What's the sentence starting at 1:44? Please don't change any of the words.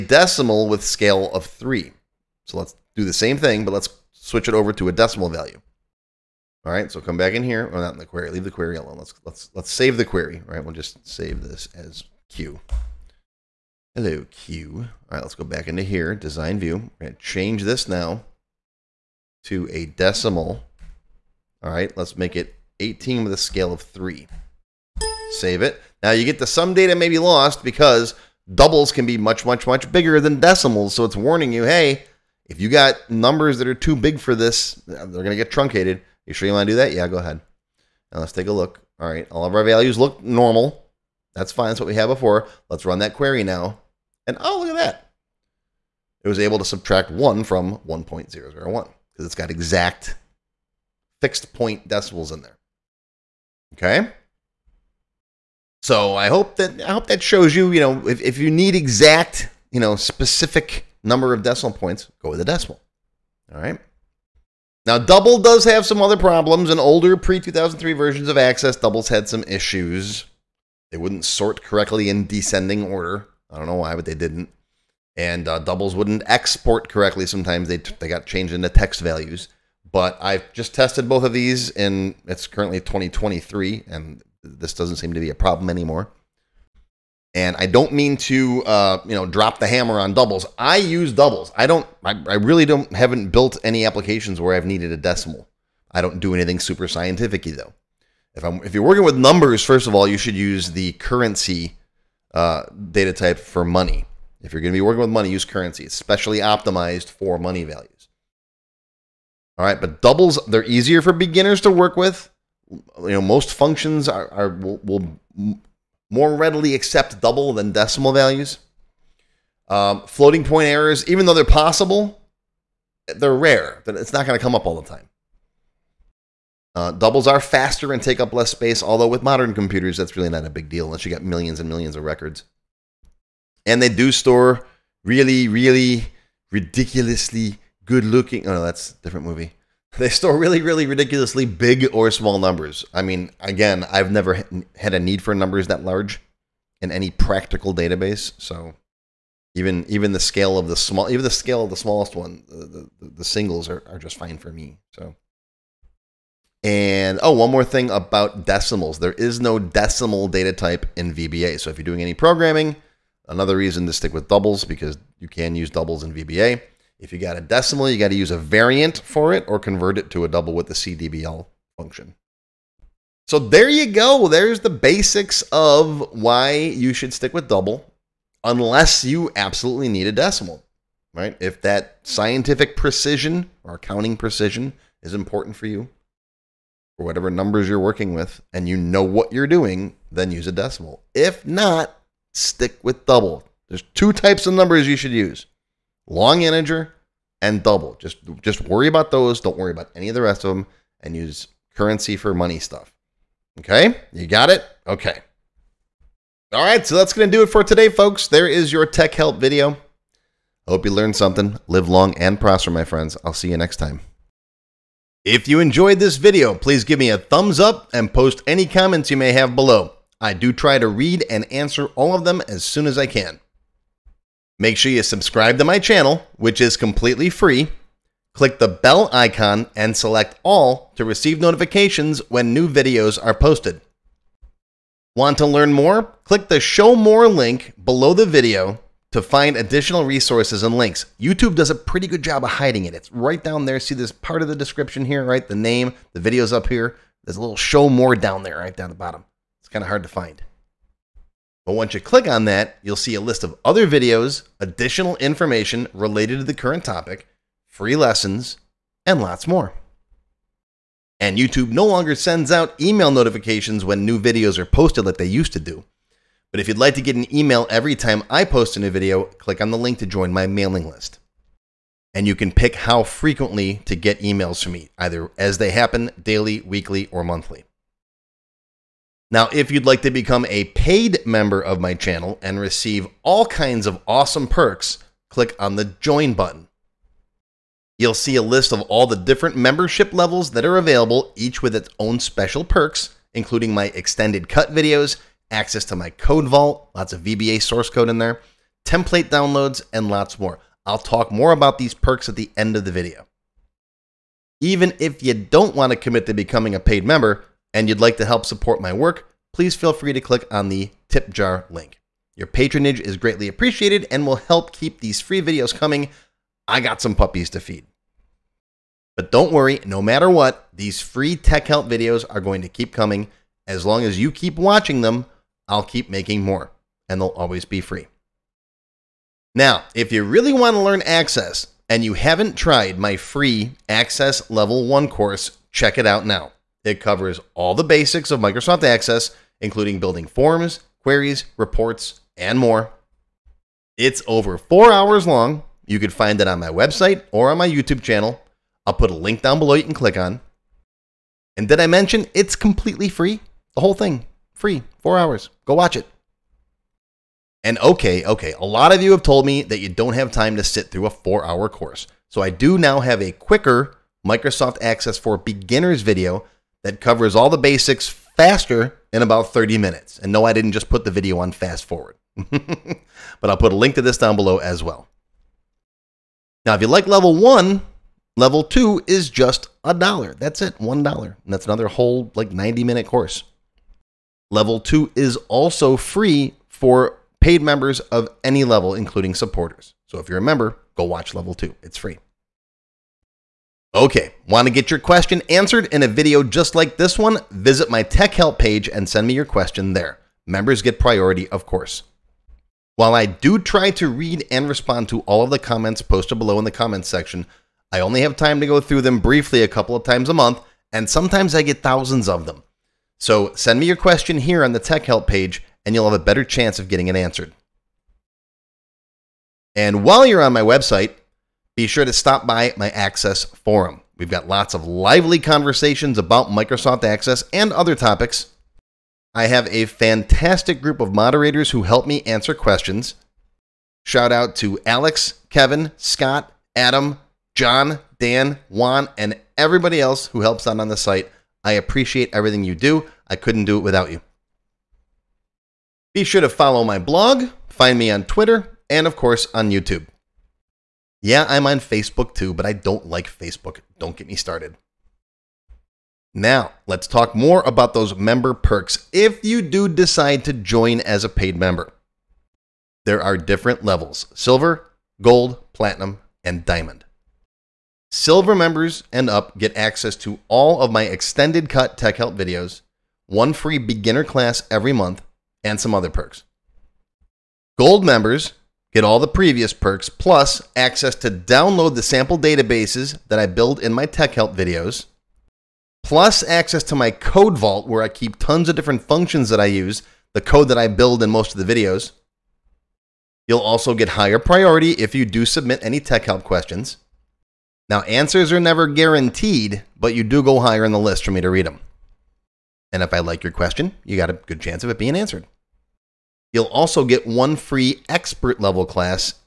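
If you're going to be working with money, use currency.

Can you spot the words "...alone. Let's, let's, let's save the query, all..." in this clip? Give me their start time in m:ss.
0:08.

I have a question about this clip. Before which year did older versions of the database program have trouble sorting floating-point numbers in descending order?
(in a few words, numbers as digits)
2003.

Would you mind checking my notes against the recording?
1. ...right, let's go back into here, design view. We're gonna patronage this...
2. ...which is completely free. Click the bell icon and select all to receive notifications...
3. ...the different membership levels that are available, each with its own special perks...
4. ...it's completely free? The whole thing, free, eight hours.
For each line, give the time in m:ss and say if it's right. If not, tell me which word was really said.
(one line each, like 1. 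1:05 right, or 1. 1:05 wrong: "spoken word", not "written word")
1. 0:15 wrong: "change", not "patronage"
2. 3:46 right
3. 4:49 right
4. 5:52 wrong: "four", not "eight".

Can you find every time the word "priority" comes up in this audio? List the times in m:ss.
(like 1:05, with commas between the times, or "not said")
6:40, 8:14.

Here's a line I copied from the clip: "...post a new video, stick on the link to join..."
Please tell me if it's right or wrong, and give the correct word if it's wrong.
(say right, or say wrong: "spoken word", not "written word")
wrong: "click", not "stick".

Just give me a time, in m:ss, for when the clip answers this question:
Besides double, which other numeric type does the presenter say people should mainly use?
3:16.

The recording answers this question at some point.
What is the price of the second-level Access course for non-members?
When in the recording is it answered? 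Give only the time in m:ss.
6:19.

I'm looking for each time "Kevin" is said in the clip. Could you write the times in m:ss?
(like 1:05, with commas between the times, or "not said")
7:15.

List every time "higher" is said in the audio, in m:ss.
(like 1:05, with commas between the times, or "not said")
8:14, 8:20.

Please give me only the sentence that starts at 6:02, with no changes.
So I do now have a quicker Microsoft Access for Beginners video that covers all the basics faster in about 30 minutes.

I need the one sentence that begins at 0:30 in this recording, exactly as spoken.
So it's warning you, hey, if you got numbers that are too big for this, they're going to get truncated.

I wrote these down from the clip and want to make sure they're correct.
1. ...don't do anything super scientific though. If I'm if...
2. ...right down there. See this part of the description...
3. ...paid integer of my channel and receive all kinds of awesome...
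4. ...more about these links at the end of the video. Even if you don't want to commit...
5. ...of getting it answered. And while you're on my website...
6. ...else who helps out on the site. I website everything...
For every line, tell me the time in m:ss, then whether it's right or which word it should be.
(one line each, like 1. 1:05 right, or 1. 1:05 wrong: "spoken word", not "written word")
1. 1:36 right
2. 4:03 right
3. 4:40 wrong: "member", not "integer"
4. 5:01 wrong: "perks", not "links"
5. 6:56 right
6. 7:19 wrong: "appreciate", not "website".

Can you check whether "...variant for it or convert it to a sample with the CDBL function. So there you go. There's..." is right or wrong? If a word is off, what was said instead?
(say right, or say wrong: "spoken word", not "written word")
wrong: "double", not "sample".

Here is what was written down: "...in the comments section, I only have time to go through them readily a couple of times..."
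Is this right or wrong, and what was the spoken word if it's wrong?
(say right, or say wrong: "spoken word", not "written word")
wrong: "briefly", not "readily".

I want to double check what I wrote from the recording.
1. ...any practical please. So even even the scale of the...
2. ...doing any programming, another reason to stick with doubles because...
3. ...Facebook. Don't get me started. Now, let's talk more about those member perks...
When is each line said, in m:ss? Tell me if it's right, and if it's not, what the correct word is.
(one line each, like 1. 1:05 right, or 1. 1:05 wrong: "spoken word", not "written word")
1. 2:26 wrong: "database", not "please"
2. 2:41 right
3. 7:33 right.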